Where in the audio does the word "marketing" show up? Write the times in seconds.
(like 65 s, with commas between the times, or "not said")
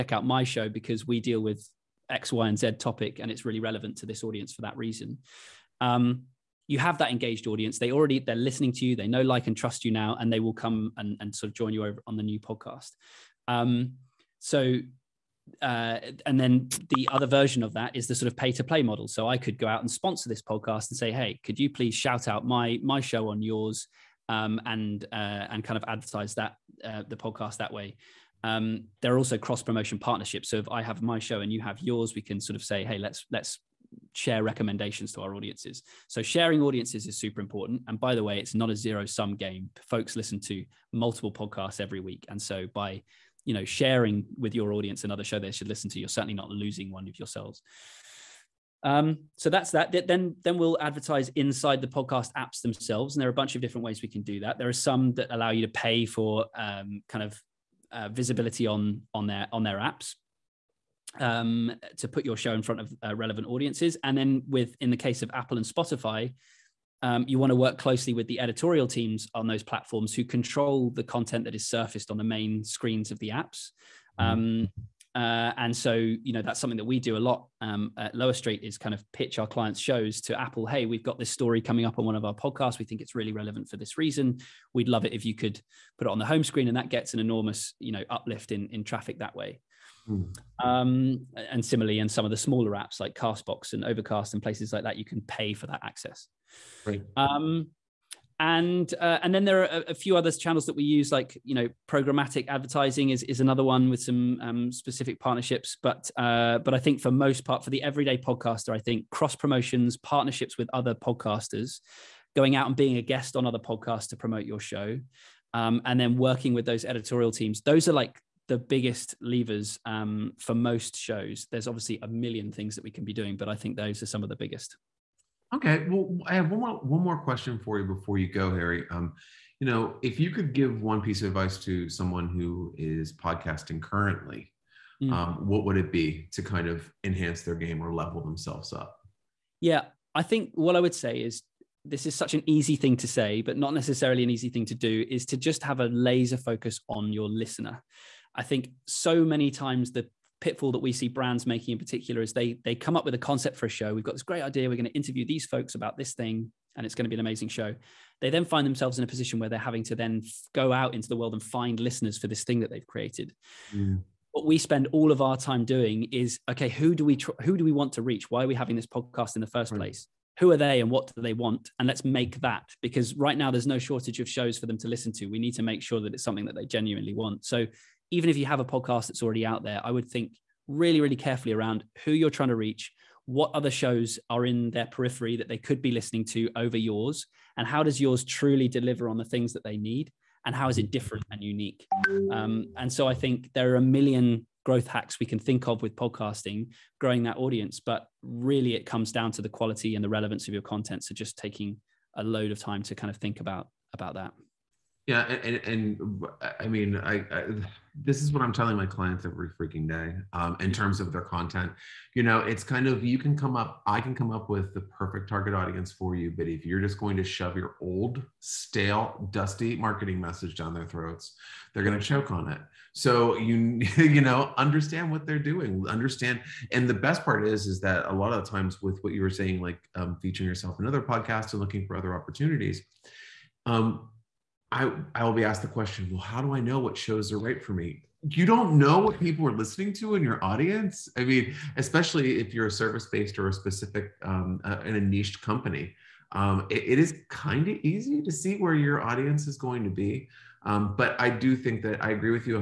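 219 s.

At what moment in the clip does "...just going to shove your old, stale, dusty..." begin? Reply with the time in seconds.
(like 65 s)
216 s.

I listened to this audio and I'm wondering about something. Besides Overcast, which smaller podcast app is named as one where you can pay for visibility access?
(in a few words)
Castbox.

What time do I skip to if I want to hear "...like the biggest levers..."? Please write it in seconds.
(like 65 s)
117 s.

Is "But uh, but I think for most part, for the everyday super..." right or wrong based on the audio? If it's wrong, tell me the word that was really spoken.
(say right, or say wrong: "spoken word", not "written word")
wrong: "podcaster", not "super".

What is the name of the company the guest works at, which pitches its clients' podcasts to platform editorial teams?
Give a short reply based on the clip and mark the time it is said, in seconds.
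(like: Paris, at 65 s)
Lower Street, at 78 s.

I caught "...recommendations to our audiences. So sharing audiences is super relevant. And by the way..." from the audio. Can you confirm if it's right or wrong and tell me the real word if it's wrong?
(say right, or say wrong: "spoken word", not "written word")
wrong: "important", not "relevant".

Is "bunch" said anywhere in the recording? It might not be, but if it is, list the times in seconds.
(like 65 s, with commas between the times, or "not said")
53 s.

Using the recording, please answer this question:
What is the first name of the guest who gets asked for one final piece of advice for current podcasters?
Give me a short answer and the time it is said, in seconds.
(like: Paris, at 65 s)
Harry, at 128 s.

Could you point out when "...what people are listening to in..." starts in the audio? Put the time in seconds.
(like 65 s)
238 s.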